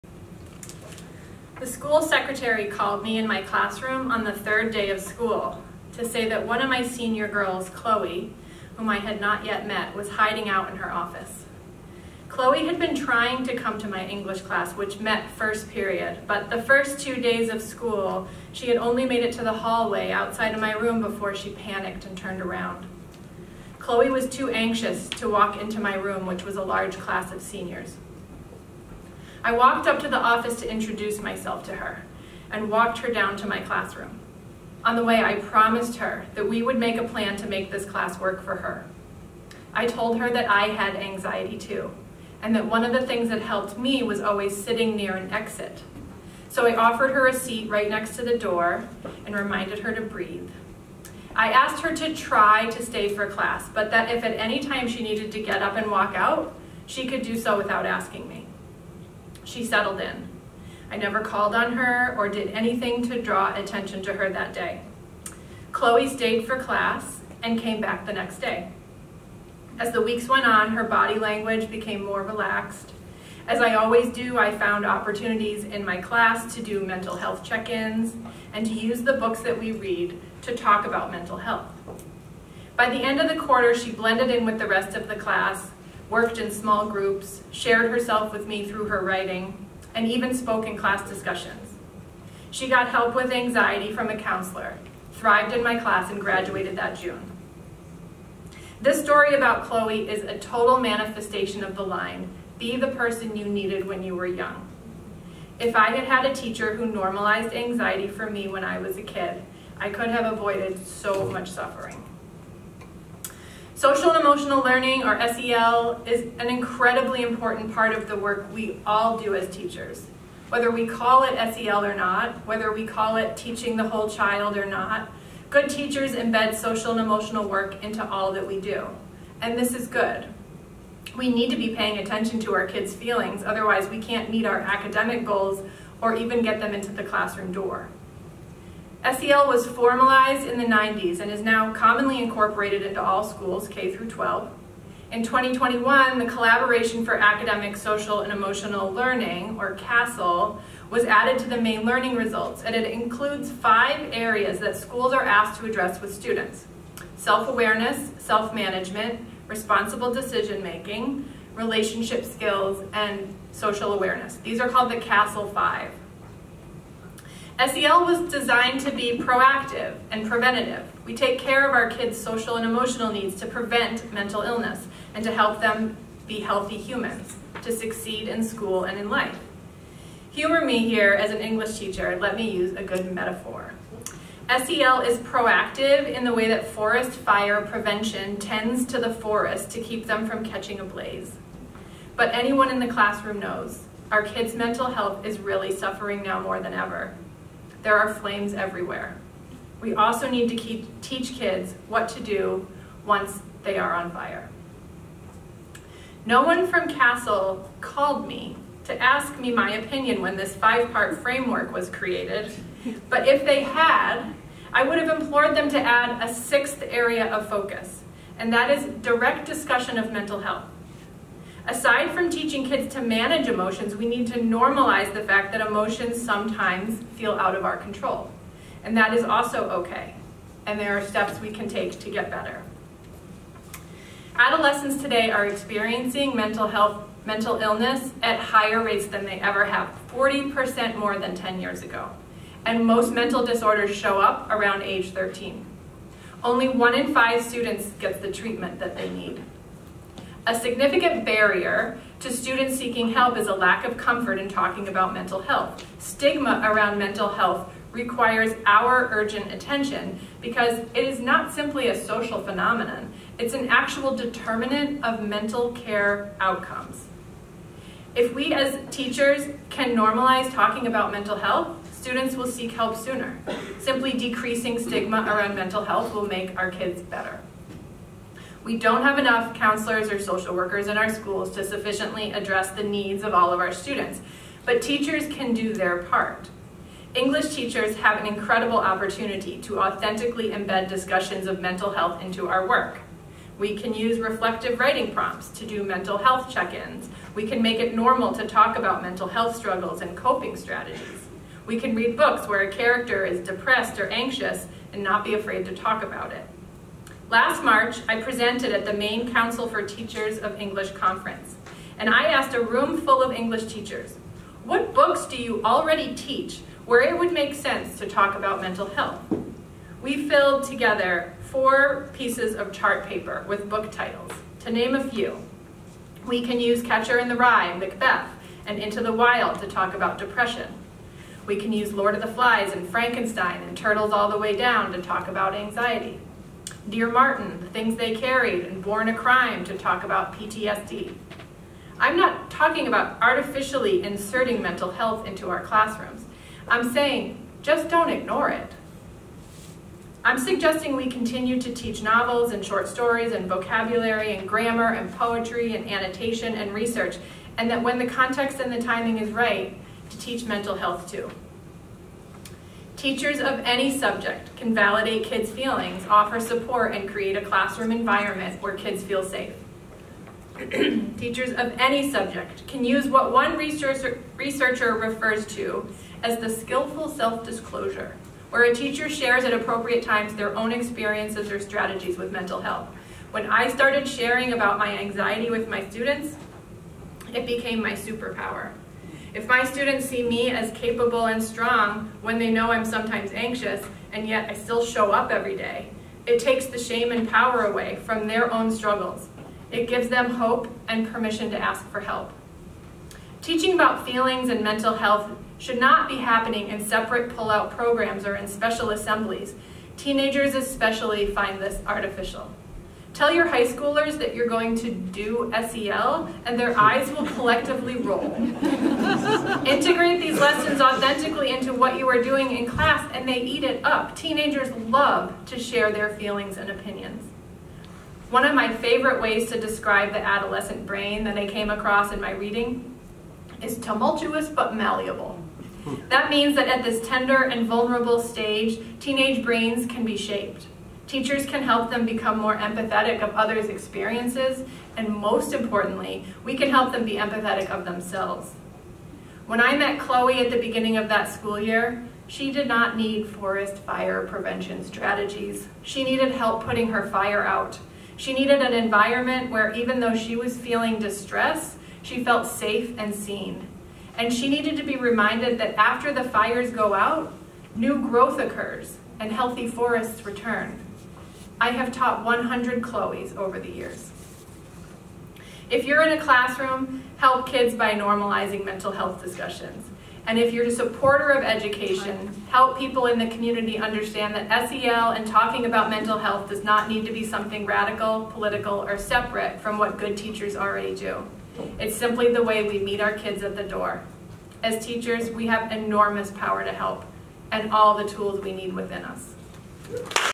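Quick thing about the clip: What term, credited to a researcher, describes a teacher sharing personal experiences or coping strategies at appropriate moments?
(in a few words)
skillful self-disclosure.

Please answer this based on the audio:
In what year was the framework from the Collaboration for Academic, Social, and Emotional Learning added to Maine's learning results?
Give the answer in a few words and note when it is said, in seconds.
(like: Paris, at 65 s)
2021, at 145 s.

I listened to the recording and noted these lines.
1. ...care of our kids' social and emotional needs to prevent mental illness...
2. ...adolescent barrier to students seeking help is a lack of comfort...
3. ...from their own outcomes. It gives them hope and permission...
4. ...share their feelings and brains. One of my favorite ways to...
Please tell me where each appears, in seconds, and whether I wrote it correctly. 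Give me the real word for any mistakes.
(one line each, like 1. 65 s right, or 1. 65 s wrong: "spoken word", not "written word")
1. 171 s right
2. 250 s wrong: "significant", not "adolescent"
3. 397 s wrong: "struggles", not "outcomes"
4. 425 s wrong: "opinions", not "brains".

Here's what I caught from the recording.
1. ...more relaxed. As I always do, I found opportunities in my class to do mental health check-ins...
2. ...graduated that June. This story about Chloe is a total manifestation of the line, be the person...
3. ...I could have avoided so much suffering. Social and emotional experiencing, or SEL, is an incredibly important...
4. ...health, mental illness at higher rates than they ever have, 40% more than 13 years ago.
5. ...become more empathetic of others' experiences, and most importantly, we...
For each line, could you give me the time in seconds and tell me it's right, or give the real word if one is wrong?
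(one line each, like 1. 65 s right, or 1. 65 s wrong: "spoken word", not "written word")
1. 72 s right
2. 96 s right
3. 109 s wrong: "learning", not "experiencing"
4. 236 s wrong: "10", not "13"
5. 442 s right.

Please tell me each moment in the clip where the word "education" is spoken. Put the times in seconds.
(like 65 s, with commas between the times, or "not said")
481 s.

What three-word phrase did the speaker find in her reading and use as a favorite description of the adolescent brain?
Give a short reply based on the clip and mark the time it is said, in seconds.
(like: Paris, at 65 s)
tumultuous but malleable, at 433 s.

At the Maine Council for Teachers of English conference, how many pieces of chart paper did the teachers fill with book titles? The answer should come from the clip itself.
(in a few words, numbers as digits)
4.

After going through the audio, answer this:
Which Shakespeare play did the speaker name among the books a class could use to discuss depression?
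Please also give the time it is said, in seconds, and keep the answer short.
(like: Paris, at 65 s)
Macbeth, at 327 s.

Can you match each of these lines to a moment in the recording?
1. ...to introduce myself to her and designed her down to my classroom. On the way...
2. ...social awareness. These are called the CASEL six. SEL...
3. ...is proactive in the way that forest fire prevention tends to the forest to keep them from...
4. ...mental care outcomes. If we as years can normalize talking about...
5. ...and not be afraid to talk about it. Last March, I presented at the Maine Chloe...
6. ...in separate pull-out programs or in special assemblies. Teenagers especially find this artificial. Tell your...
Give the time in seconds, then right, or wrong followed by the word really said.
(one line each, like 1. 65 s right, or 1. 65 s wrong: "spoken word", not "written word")
1. 30 s wrong: "walked", not "designed"
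2. 163 s wrong: "five", not "six"
3. 185 s right
4. 265 s wrong: "teachers", not "years"
5. 304 s wrong: "Council", not "Chloe"
6. 406 s right.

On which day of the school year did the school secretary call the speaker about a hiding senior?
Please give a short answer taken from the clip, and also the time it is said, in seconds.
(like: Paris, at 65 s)
third day, at 4 s.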